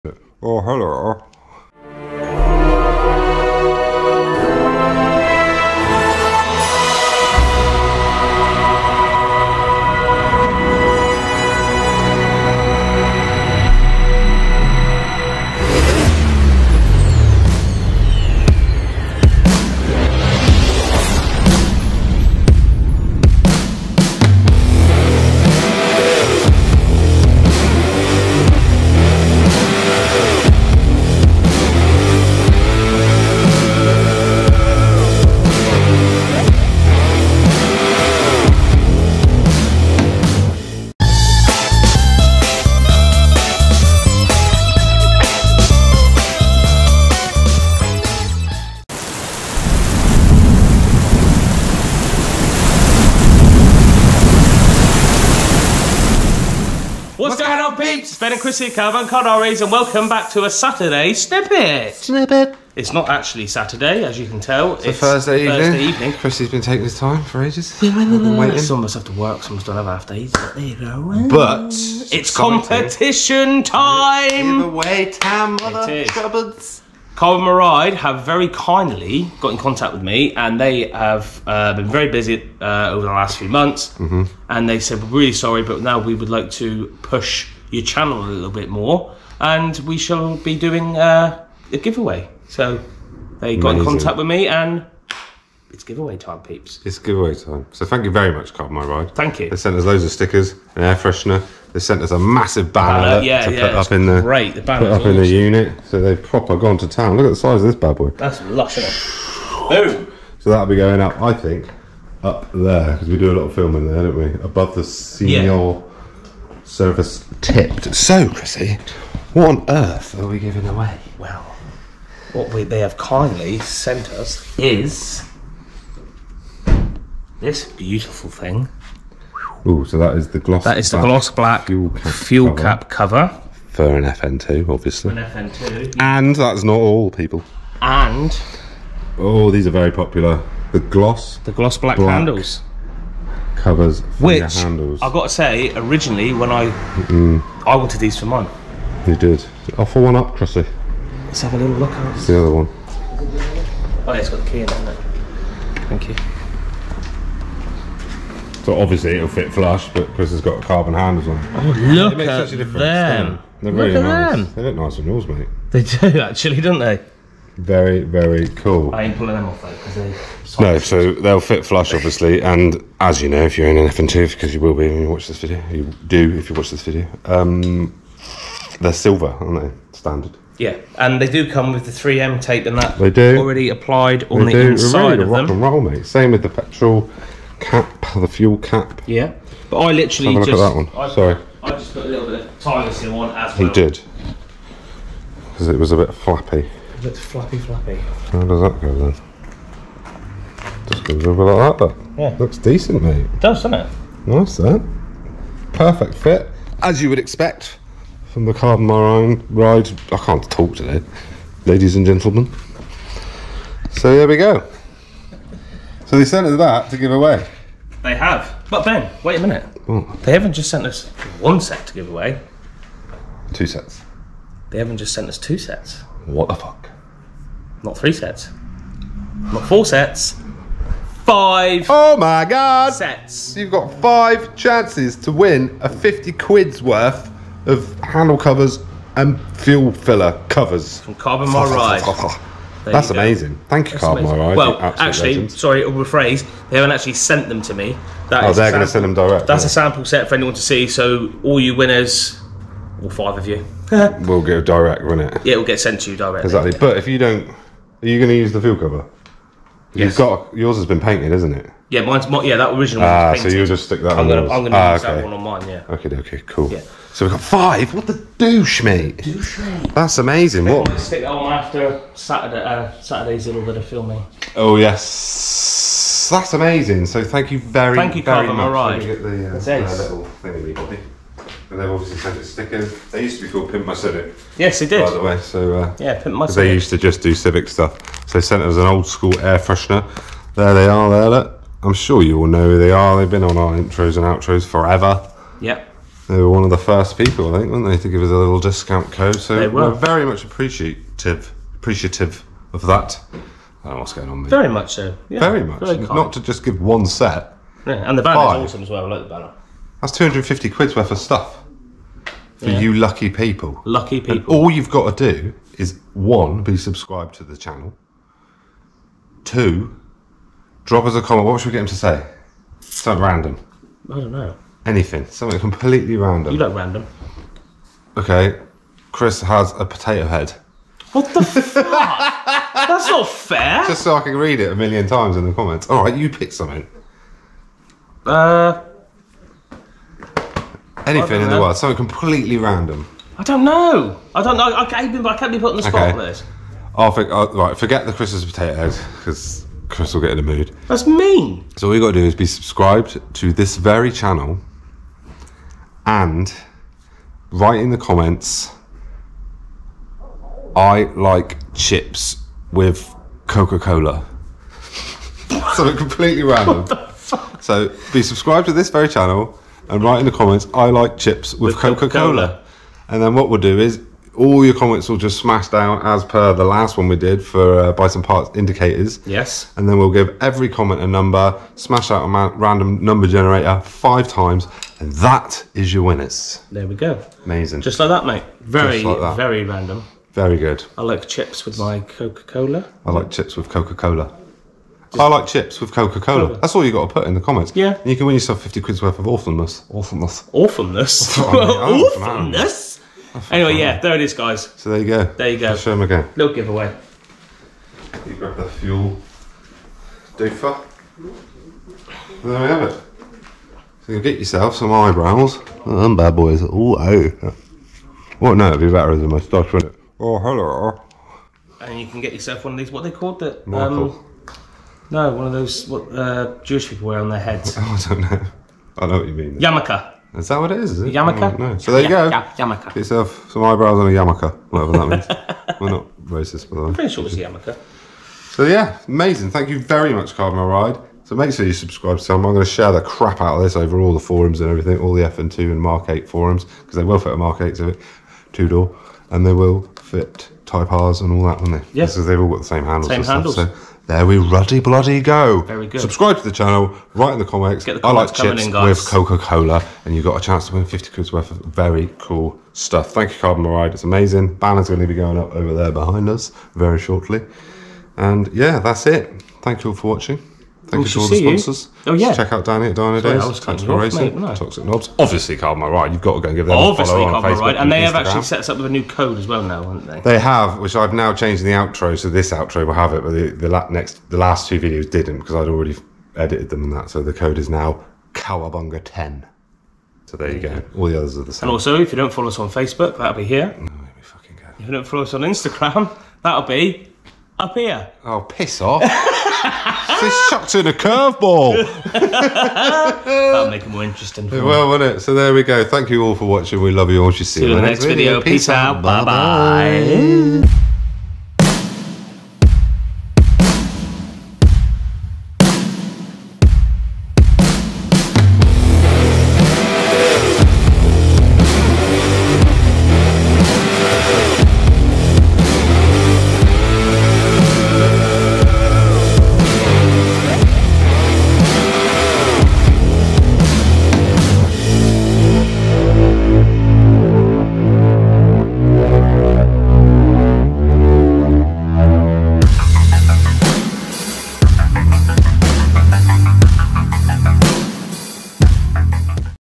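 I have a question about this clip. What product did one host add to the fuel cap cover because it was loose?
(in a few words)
Tiger seal.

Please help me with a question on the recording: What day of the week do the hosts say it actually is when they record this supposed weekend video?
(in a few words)
Thursday.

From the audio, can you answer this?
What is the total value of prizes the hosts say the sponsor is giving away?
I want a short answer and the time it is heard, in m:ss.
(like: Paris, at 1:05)
£250, at 5:10.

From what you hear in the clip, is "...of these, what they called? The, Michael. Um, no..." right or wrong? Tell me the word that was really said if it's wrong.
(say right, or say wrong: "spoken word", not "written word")
right.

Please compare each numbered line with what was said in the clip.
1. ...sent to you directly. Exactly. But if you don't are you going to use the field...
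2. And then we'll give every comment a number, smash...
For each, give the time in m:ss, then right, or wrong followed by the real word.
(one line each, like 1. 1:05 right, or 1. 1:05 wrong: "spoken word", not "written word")
1. 4:15 right
2. 6:19 right.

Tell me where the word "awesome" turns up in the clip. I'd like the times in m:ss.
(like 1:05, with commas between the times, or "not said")
1:45, 5:08.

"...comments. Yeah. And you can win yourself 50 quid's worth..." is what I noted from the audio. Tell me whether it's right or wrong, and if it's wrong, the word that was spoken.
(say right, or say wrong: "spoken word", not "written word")
right.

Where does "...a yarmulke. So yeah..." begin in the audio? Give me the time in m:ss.
7:17.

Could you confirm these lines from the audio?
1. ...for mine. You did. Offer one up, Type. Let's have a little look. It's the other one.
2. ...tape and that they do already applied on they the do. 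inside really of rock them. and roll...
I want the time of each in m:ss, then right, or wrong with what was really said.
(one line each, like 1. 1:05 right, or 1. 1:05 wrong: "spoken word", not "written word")
1. 2:28 wrong: "Crossy", not "Type"
2. 3:02 right.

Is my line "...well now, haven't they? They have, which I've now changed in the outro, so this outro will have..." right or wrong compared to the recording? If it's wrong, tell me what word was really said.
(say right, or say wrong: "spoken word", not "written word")
right.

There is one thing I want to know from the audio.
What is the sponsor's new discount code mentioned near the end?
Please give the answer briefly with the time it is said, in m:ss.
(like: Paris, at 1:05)
Cowabunga ten, at 8:08.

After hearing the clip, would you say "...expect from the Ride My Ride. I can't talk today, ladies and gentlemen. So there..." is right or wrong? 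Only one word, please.
wrong.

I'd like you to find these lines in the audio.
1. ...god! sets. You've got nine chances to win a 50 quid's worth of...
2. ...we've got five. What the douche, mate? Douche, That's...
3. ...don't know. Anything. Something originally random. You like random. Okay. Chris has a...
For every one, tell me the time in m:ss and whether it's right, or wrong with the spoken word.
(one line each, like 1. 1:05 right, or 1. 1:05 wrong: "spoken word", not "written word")
1. 3:52 wrong: "five", not "nine"
2. 4:27 right
3. 5:24 wrong: "completely", not "originally".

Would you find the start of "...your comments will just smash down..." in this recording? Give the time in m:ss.
6:14.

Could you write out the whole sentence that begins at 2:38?
So obviously it'll fit flush, but Chris has got carbon handles on.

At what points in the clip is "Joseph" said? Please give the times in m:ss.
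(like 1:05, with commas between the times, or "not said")
not said.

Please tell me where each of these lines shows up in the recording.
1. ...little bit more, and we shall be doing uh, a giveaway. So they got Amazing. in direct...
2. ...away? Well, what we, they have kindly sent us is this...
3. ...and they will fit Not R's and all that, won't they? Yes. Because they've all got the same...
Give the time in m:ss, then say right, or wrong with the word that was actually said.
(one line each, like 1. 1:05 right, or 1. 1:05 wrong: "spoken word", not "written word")
1. 1:28 wrong: "contact", not "direct"
2. 2:00 right
3. 7:29 wrong: "Type", not "Not".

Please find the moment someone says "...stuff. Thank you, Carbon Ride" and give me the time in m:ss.
7:42.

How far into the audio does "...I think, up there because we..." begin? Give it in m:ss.
1:51.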